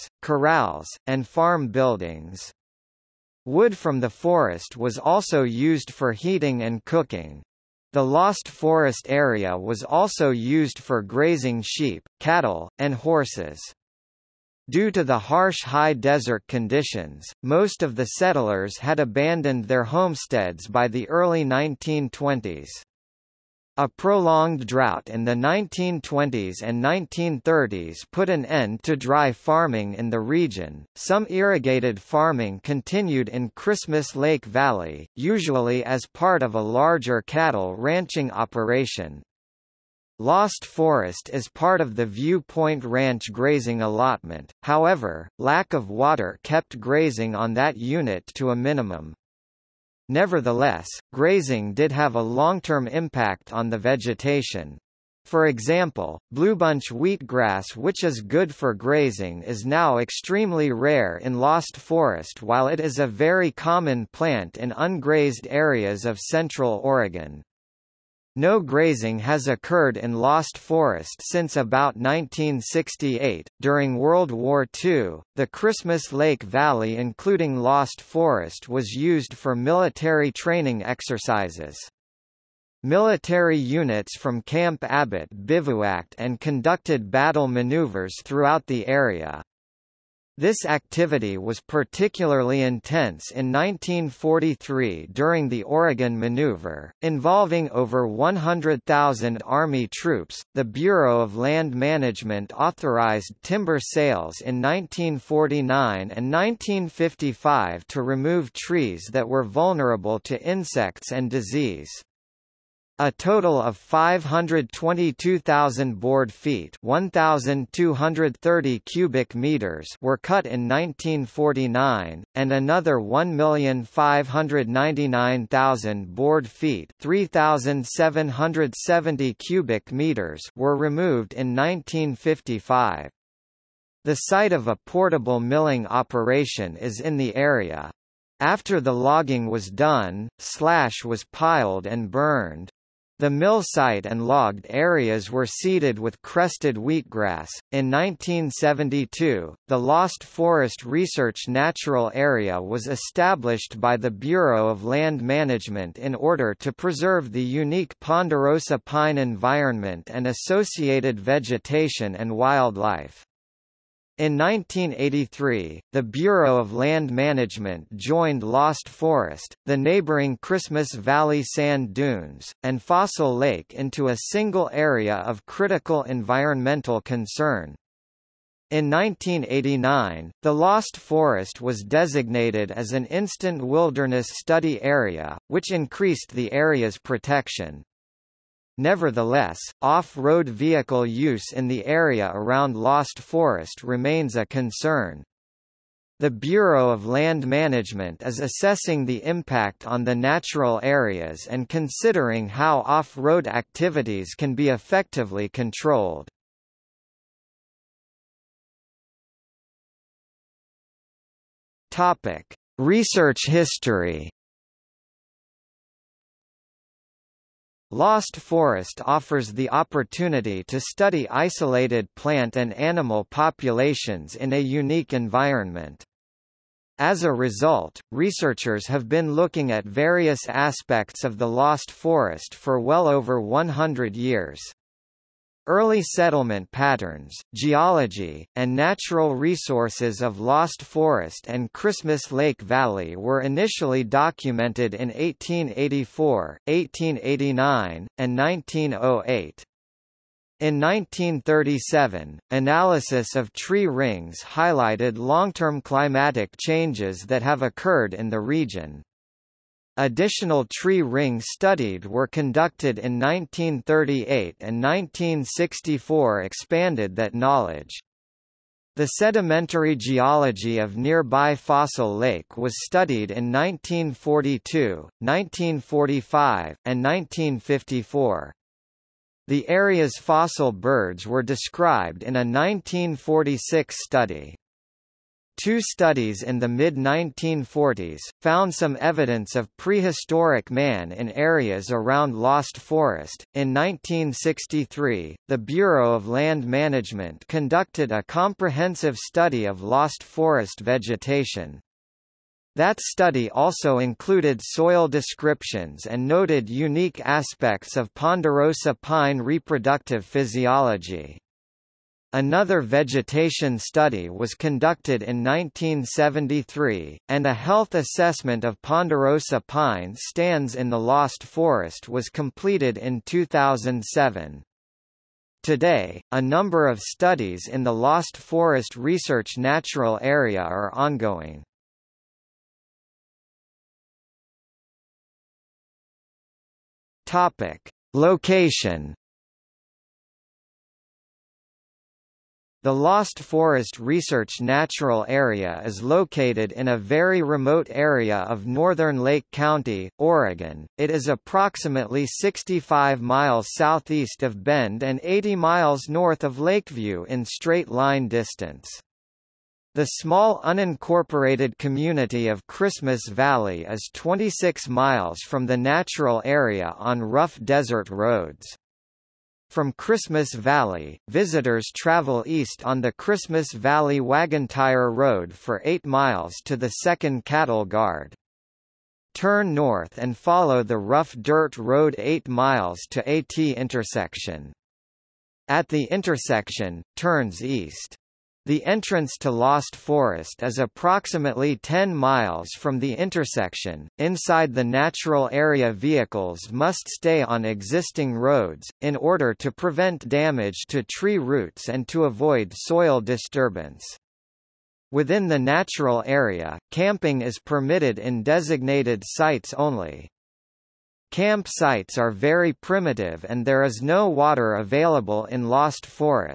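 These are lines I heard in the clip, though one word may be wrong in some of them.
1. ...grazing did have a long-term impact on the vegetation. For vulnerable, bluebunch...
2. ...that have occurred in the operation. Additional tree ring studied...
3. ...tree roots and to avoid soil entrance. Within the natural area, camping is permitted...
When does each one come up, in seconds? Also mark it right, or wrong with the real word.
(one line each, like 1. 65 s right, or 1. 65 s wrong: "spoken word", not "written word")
1. 51 s wrong: "example", not "vulnerable"
2. 257 s wrong: "region", not "operation"
3. 401 s wrong: "disturbance", not "entrance".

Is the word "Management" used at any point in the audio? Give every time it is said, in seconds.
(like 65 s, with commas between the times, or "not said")
101 s, 155 s, 167 s, 197 s, 296 s.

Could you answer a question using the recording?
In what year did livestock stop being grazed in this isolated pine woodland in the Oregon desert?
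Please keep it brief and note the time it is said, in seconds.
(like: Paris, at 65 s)
1968, at 71 s.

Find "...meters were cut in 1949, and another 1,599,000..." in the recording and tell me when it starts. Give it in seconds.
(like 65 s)
119 s.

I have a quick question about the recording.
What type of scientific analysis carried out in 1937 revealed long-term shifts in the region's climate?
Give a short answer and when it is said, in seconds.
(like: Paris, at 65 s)
tree rings, at 253 s.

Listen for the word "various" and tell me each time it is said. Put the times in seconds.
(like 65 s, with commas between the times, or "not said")
229 s.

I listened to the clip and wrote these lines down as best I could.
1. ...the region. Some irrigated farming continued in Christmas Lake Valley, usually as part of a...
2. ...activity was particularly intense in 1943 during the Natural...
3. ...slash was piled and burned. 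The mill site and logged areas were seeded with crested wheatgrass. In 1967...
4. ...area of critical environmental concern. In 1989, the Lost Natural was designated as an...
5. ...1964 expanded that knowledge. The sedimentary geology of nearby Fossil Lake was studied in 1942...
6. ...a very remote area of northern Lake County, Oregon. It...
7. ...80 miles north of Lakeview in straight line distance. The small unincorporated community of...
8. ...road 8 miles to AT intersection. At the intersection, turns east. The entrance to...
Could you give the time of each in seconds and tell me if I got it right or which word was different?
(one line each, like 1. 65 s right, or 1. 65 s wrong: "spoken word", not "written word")
1. 30 s right
2. 90 s wrong: "Oregon", not "Natural"
3. 140 s wrong: "1972", not "1967"
4. 174 s wrong: "Forest", not "Natural"
5. 264 s right
6. 346 s right
7. 355 s right
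8. 381 s right.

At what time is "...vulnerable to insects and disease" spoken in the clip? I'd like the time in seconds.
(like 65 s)
109 s.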